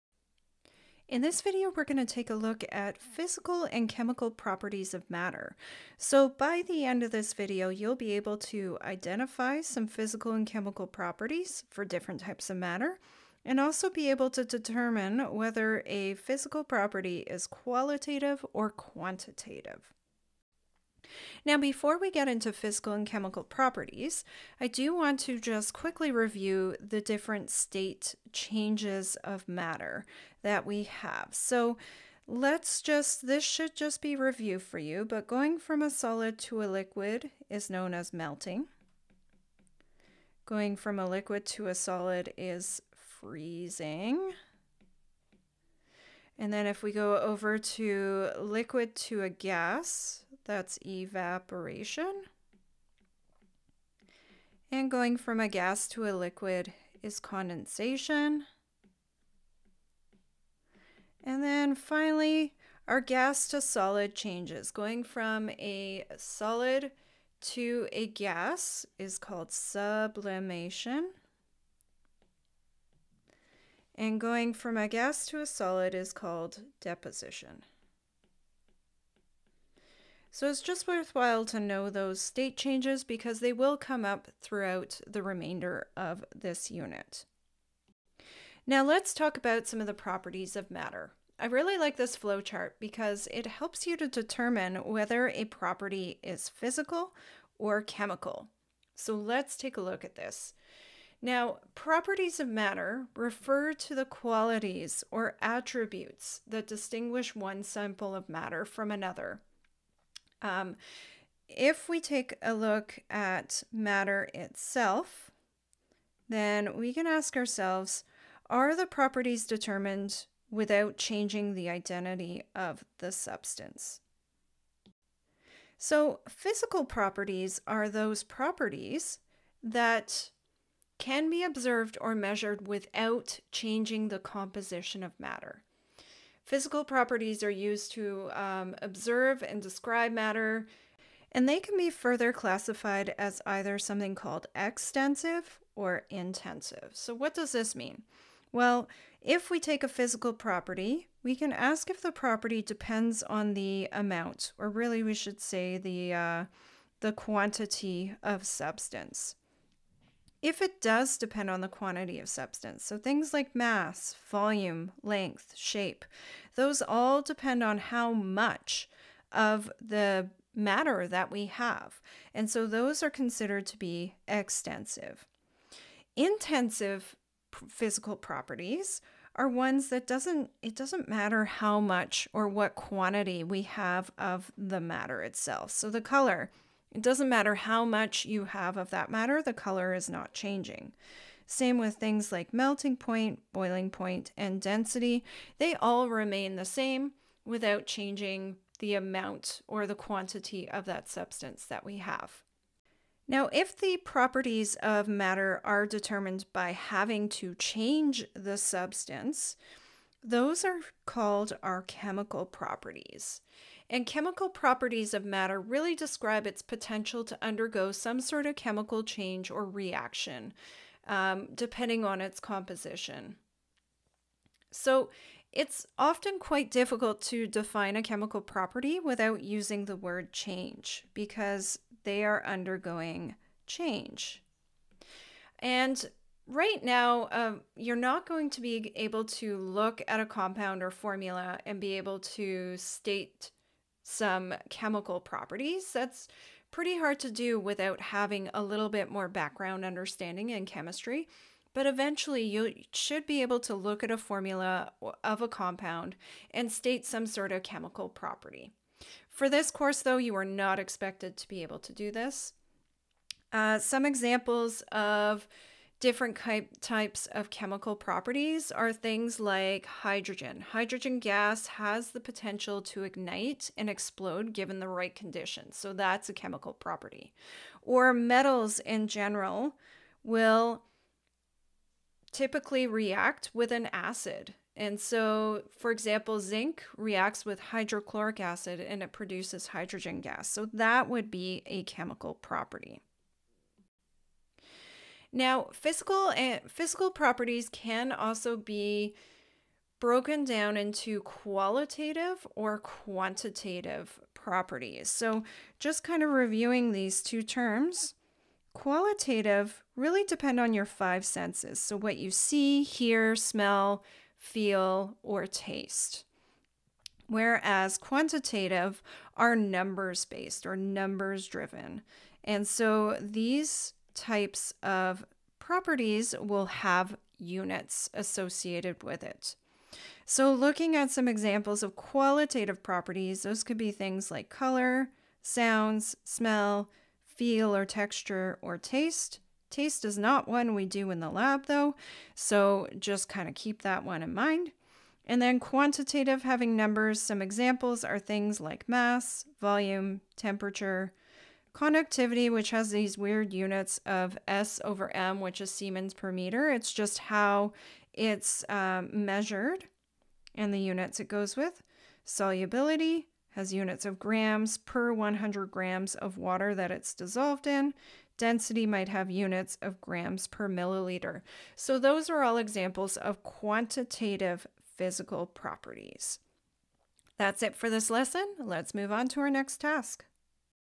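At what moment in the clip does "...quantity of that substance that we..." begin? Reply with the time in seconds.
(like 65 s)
199 s.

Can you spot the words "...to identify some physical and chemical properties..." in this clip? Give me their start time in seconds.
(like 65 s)
8 s.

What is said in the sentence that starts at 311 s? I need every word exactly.
So, what you see, hear, smell, feel, or taste.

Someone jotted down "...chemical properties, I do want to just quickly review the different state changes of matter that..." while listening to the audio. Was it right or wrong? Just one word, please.
right.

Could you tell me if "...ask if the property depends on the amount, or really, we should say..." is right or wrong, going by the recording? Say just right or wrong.
right.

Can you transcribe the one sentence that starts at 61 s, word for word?
And then finally, our gas to solid changes.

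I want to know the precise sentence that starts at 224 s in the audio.
So, it's often quite difficult to define a chemical property without using the word change because they are undergoing change.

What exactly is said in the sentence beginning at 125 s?
So, physical properties are those properties that can be observed or measured without changing the composition of matter.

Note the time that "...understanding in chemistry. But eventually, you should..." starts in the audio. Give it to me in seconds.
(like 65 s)
249 s.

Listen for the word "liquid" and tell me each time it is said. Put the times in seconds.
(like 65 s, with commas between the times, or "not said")
36 s, 41 s, 48 s, 56 s.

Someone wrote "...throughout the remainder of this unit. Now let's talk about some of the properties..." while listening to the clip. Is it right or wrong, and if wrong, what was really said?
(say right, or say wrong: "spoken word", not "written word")
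right.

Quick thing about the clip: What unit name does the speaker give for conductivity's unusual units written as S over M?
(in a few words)
Siemens per meter.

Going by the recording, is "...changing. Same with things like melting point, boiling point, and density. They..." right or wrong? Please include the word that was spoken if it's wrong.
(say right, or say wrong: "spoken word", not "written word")
right.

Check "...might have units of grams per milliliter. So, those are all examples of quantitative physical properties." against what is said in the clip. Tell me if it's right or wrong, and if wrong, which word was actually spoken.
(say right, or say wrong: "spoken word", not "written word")
right.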